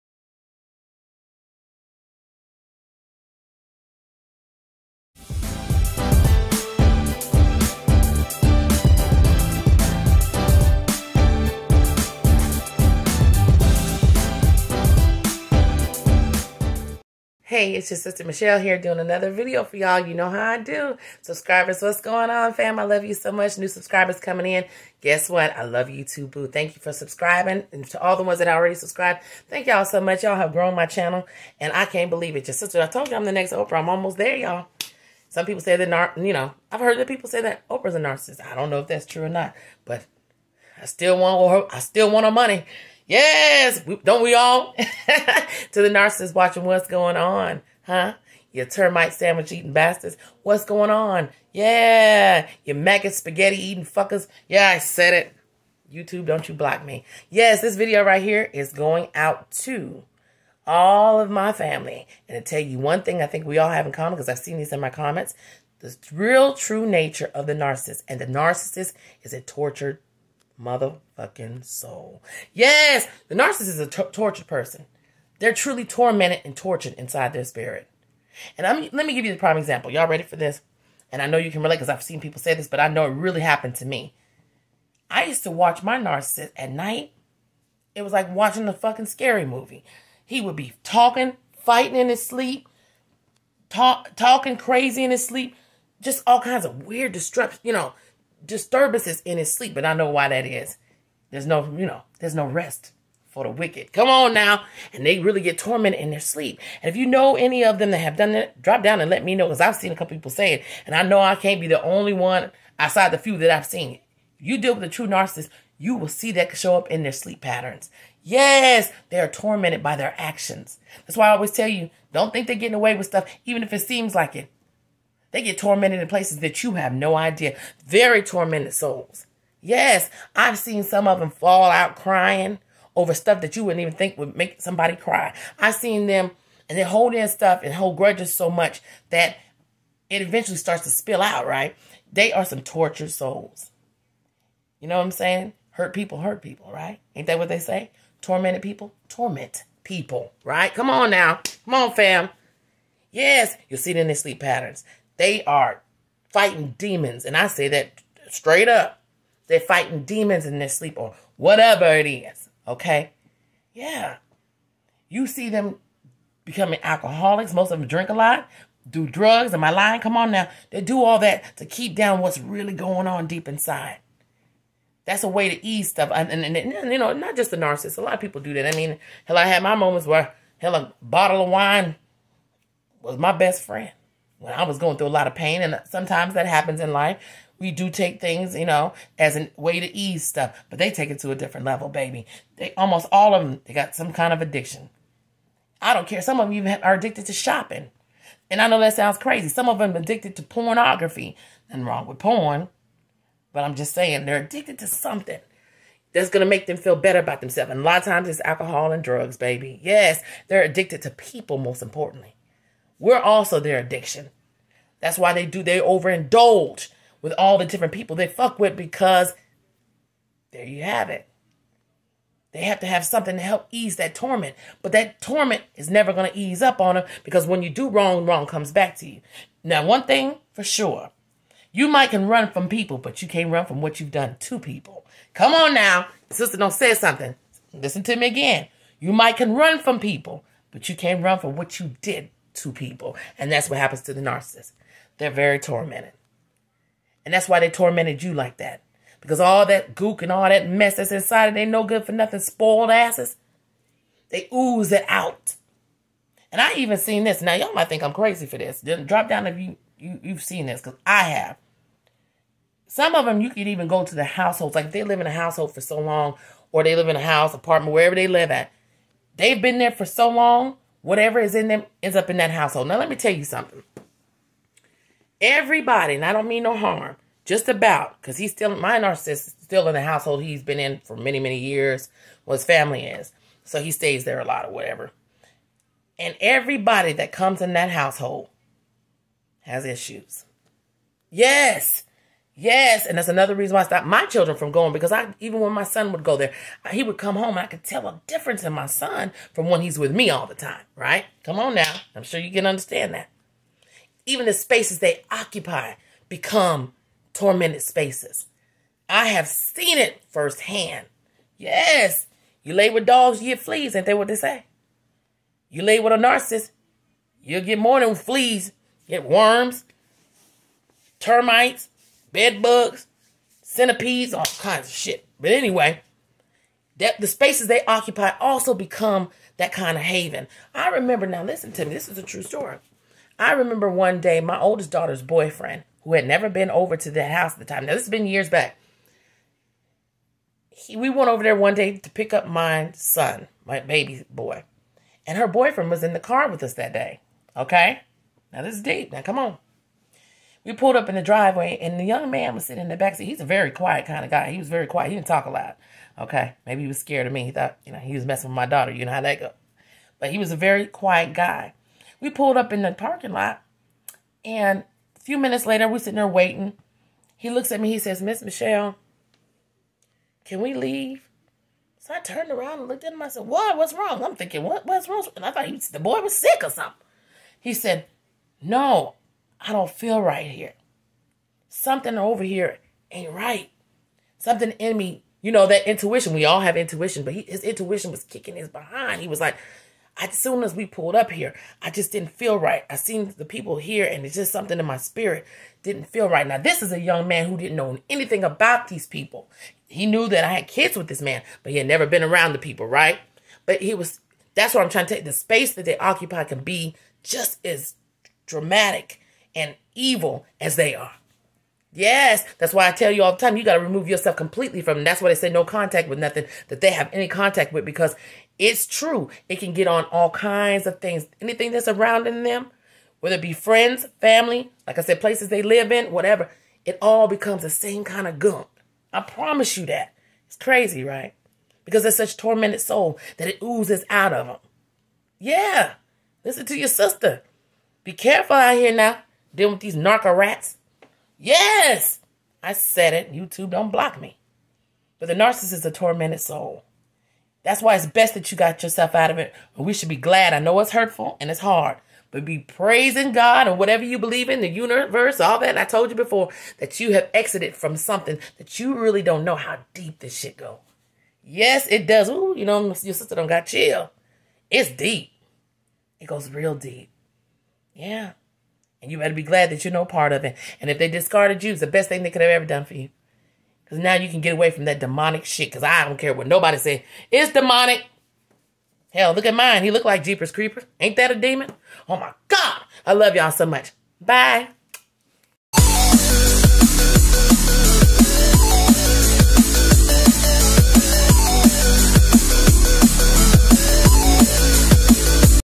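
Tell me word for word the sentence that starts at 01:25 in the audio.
I used to watch my narcissist at night.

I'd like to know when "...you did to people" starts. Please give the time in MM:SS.
04:01.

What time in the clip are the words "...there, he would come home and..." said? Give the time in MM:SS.
04:56.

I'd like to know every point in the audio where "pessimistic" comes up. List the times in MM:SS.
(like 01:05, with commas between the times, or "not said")
not said.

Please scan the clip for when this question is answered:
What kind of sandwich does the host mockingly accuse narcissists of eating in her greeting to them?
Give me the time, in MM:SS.
00:48.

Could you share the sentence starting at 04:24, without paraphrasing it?
Like they live in a household for so long, or they live in a house, apartment, wherever they live at.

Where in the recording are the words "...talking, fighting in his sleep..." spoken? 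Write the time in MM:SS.
01:30.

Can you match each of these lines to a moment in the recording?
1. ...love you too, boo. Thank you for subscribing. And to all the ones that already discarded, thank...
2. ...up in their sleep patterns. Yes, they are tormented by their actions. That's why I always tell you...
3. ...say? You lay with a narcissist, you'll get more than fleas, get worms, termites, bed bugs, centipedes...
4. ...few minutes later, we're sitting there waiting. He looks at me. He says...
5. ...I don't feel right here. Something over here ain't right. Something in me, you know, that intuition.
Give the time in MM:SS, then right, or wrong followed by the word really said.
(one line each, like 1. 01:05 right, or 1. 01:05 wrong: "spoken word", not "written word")
1. 00:25 wrong: "subscribed", not "discarded"
2. 01:56 right
3. 05:14 right
4. 06:05 right
5. 06:19 right.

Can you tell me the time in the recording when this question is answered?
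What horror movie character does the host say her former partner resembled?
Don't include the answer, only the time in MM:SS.
08:00.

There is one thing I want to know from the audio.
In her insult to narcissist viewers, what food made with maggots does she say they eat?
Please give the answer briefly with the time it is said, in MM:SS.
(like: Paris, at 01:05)
maggot spaghetti, at 00:52.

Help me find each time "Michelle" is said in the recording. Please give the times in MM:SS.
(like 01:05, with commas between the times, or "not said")
00:18, 06:08.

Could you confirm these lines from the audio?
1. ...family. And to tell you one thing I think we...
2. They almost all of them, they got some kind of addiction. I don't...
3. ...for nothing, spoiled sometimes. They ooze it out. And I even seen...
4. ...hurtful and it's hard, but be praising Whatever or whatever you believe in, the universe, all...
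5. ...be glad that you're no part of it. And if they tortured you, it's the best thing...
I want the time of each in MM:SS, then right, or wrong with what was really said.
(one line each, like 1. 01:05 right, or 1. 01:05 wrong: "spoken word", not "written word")
1. 01:01 right
2. 03:12 right
3. 04:12 wrong: "asses", not "sometimes"
4. 07:30 wrong: "God", not "Whatever"
5. 07:49 wrong: "discarded", not "tortured".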